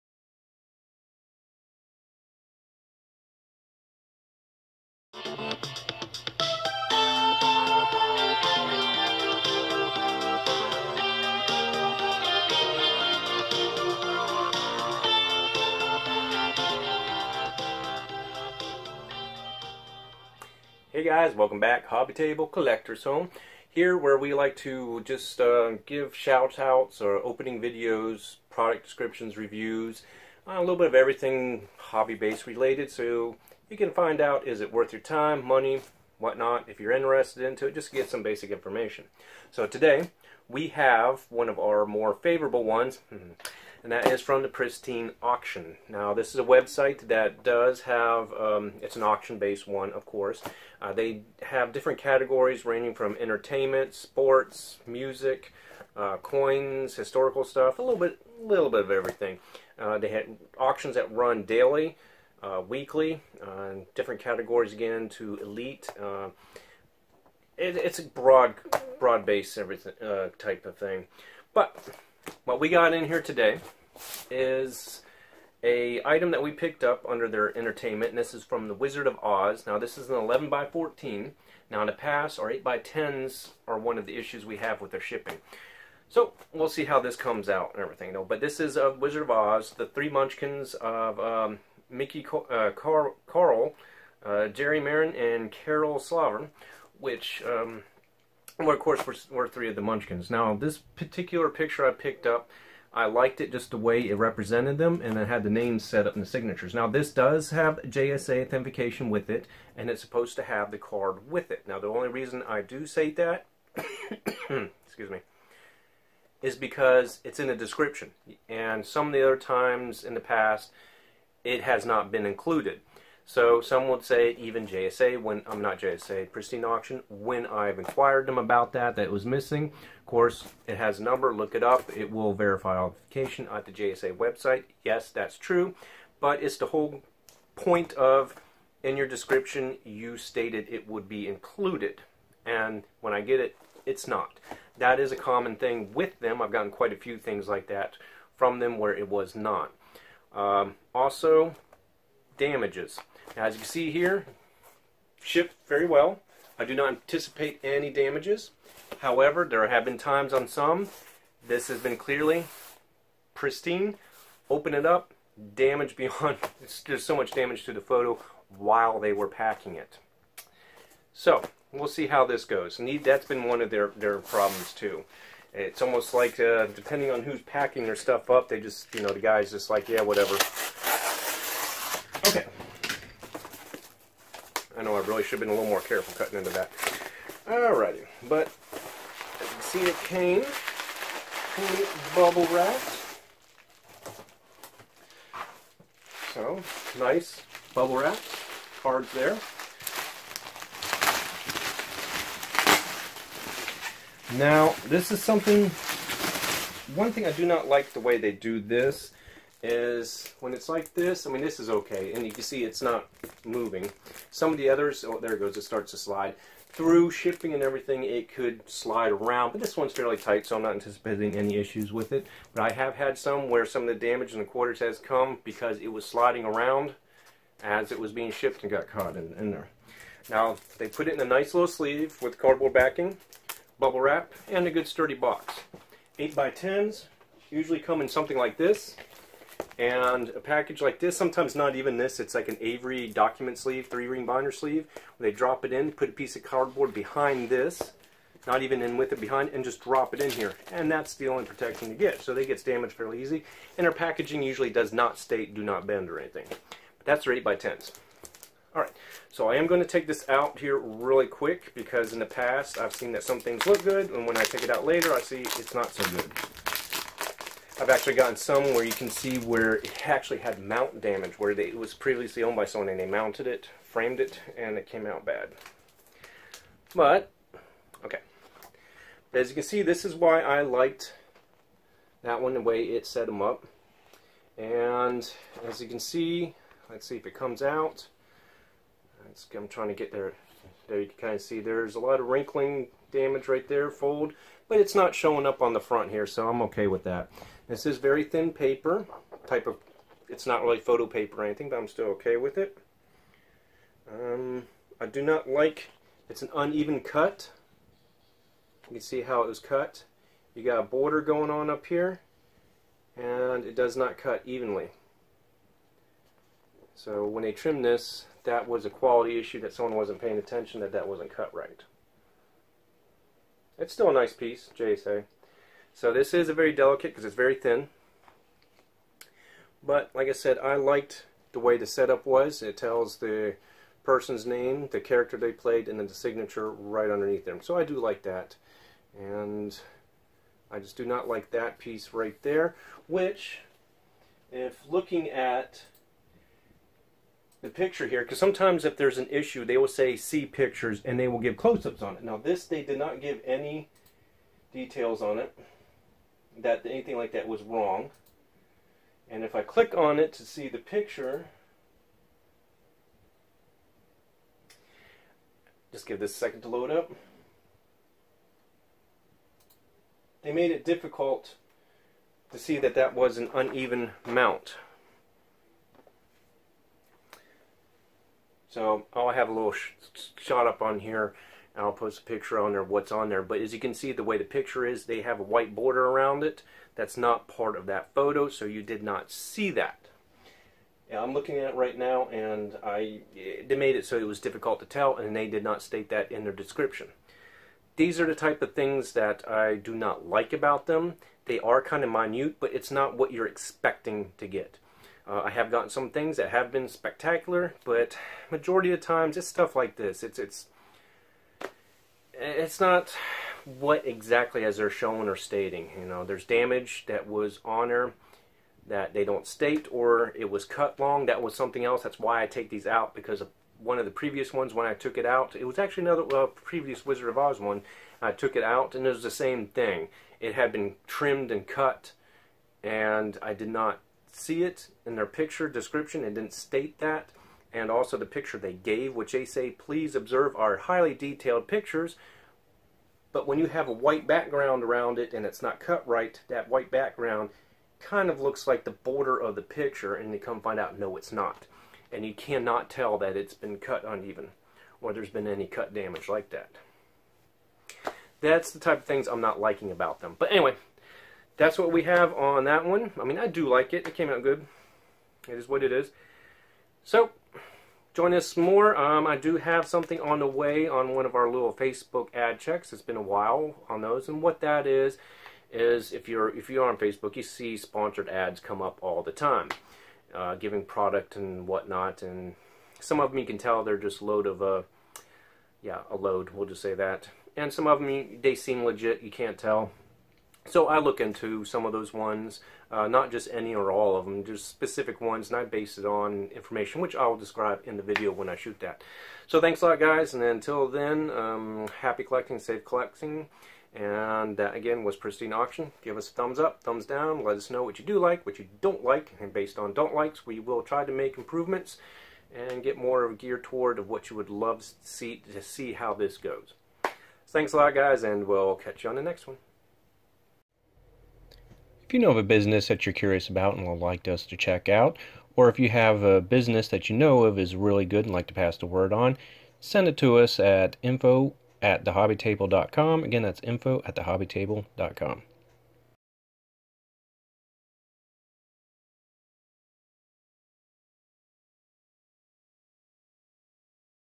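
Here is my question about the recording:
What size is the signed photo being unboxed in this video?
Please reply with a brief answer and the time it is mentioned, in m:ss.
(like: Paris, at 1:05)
11 by 14, at 1:20.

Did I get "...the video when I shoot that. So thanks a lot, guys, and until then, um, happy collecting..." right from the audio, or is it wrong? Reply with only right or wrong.
right.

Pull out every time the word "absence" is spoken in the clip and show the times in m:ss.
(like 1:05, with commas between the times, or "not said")
not said.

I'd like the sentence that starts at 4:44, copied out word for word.
And as you can see, let's see if it comes out.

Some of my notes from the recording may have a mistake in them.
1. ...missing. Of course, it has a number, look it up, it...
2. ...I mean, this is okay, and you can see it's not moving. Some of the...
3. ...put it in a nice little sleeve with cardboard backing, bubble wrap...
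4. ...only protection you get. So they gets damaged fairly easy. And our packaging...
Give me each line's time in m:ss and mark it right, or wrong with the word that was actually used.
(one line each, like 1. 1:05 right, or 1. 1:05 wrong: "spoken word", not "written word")
1. 2:09 right
2. 3:31 right
3. 3:50 right
4. 4:11 right.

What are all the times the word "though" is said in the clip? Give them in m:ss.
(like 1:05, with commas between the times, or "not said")
1:28.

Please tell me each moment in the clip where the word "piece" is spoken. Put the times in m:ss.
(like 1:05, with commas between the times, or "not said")
4:06, 5:24, 5:41.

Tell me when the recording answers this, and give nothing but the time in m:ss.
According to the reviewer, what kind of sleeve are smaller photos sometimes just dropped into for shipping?
4:02.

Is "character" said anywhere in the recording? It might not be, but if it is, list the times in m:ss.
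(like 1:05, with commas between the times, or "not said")
5:35.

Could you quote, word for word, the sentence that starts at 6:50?
It's it's it's not what exactly as they're showing or stating.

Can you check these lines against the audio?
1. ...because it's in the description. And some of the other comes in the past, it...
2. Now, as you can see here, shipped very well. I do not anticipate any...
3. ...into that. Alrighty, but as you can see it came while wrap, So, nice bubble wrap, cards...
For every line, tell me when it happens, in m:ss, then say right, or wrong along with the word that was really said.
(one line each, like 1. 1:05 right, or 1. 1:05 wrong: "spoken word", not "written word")
1. 1:56 wrong: "times", not "comes"
2. 2:33 right
3. 3:06 wrong: "bubble", not "while".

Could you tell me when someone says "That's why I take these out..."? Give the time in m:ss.
7:02.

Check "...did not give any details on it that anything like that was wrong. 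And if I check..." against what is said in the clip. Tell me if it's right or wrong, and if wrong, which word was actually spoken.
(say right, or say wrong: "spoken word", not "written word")
wrong: "click", not "check".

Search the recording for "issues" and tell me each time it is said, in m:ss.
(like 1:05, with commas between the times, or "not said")
1:24, 3:41, 5:19, 5:49.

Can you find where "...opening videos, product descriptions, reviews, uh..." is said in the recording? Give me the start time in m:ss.
0:27.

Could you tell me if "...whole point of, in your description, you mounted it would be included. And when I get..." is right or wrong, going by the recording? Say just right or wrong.
wrong.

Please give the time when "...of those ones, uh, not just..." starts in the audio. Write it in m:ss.
8:11.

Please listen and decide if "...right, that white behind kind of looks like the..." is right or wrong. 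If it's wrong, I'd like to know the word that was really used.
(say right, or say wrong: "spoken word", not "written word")
wrong: "background", not "behind".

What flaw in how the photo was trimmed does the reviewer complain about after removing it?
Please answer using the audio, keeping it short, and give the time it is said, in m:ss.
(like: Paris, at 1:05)
uneven cut, at 5:06.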